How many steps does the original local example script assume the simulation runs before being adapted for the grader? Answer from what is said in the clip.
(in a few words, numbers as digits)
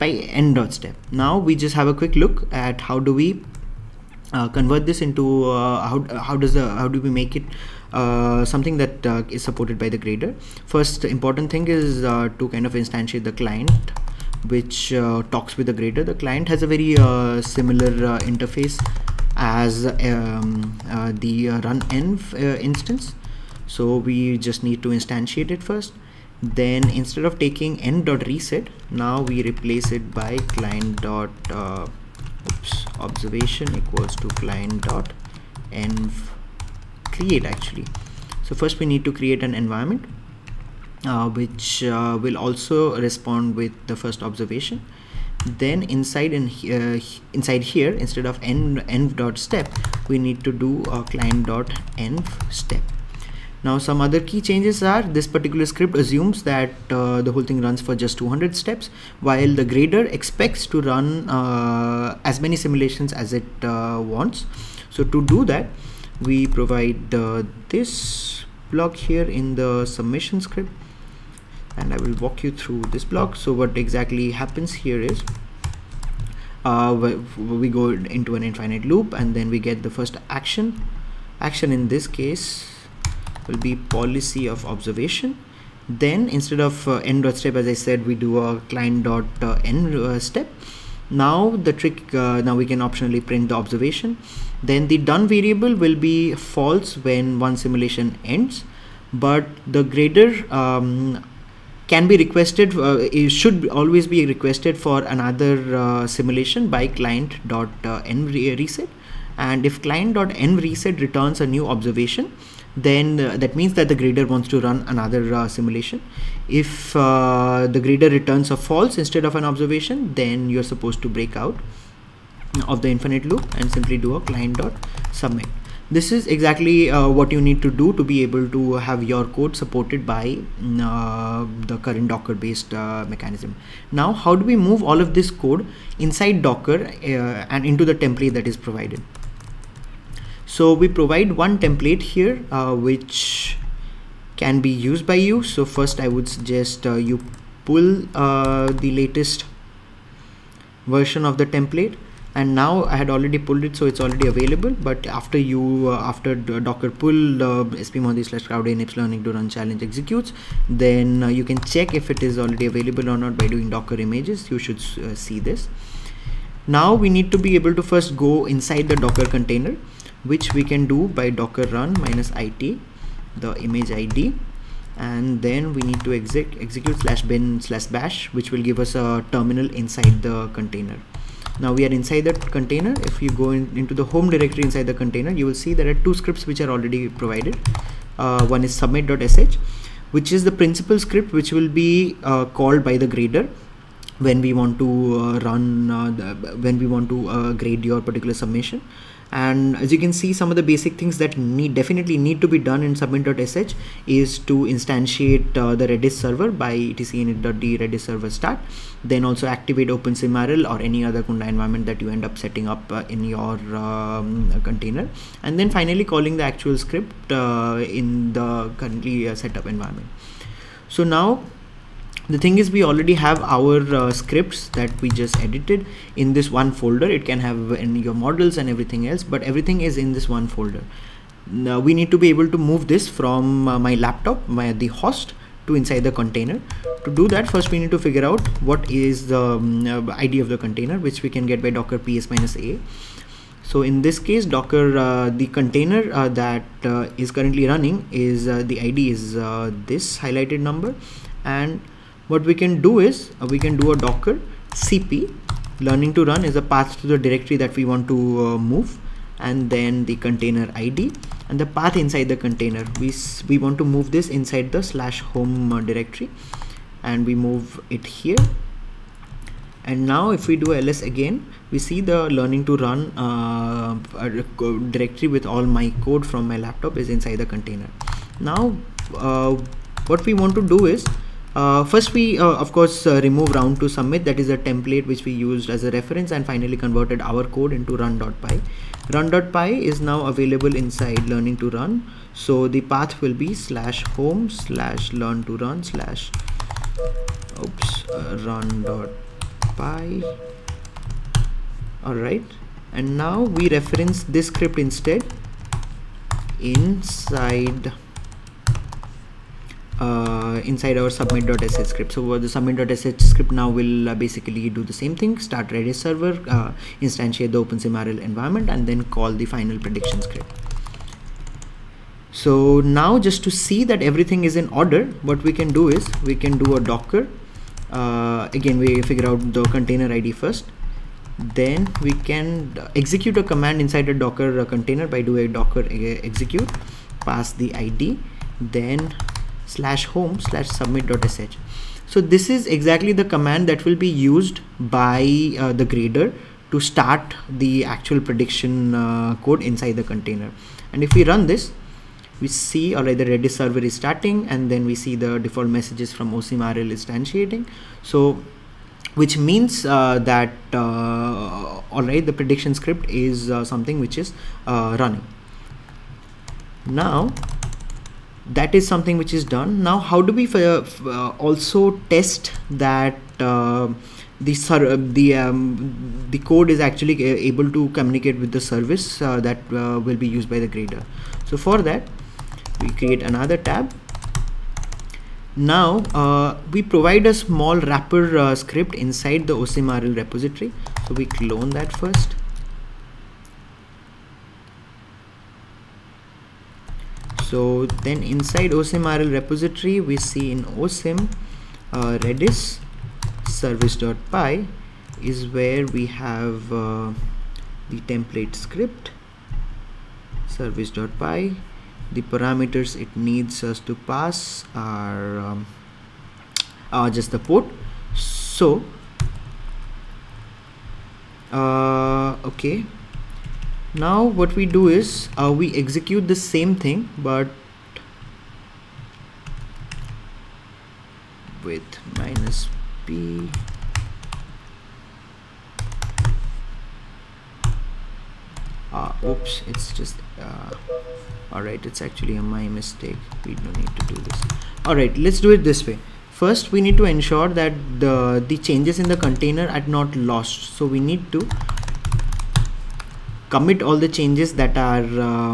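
200.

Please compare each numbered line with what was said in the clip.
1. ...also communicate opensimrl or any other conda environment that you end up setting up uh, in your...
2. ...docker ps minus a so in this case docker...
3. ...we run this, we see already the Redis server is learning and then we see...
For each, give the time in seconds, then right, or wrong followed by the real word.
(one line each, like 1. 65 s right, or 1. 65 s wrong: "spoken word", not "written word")
1. 209 s wrong: "activate", not "communicate"
2. 241 s right
3. 351 s wrong: "starting", not "learning".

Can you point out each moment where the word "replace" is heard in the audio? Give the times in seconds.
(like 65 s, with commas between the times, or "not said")
29 s.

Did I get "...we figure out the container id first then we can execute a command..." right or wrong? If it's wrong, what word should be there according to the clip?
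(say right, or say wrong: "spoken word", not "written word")
right.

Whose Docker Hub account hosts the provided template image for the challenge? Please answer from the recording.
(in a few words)
spmohanty.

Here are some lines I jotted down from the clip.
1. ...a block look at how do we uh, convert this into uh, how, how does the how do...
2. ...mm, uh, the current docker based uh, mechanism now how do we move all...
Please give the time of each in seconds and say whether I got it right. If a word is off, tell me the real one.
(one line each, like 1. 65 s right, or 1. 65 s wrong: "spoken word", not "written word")
1. 1 s wrong: "quick", not "block"
2. 130 s right.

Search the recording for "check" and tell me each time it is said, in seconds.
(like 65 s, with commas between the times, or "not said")
161 s.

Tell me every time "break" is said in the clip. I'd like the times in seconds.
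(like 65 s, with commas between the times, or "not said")
121 s.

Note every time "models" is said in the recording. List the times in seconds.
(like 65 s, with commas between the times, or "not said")
228 s.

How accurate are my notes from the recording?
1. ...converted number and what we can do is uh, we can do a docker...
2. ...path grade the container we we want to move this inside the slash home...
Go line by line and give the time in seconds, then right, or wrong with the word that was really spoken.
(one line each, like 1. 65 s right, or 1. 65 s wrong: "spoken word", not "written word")
1. 250 s wrong: "highlighted", not "converted"
2. 261 s wrong: "inside", not "grade".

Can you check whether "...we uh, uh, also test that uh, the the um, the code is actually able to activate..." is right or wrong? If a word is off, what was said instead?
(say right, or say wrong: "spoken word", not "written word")
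wrong: "communicate", not "activate".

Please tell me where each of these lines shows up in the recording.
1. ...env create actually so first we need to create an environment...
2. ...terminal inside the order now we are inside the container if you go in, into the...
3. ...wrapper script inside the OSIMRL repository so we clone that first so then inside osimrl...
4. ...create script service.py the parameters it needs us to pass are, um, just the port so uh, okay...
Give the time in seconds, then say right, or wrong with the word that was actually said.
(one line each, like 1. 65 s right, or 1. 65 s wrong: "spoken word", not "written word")
1. 35 s right
2. 179 s wrong: "container", not "order"
3. 387 s right
4. 408 s wrong: "template", not "create".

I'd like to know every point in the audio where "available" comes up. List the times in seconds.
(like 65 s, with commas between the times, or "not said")
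154 s, 162 s, 290 s.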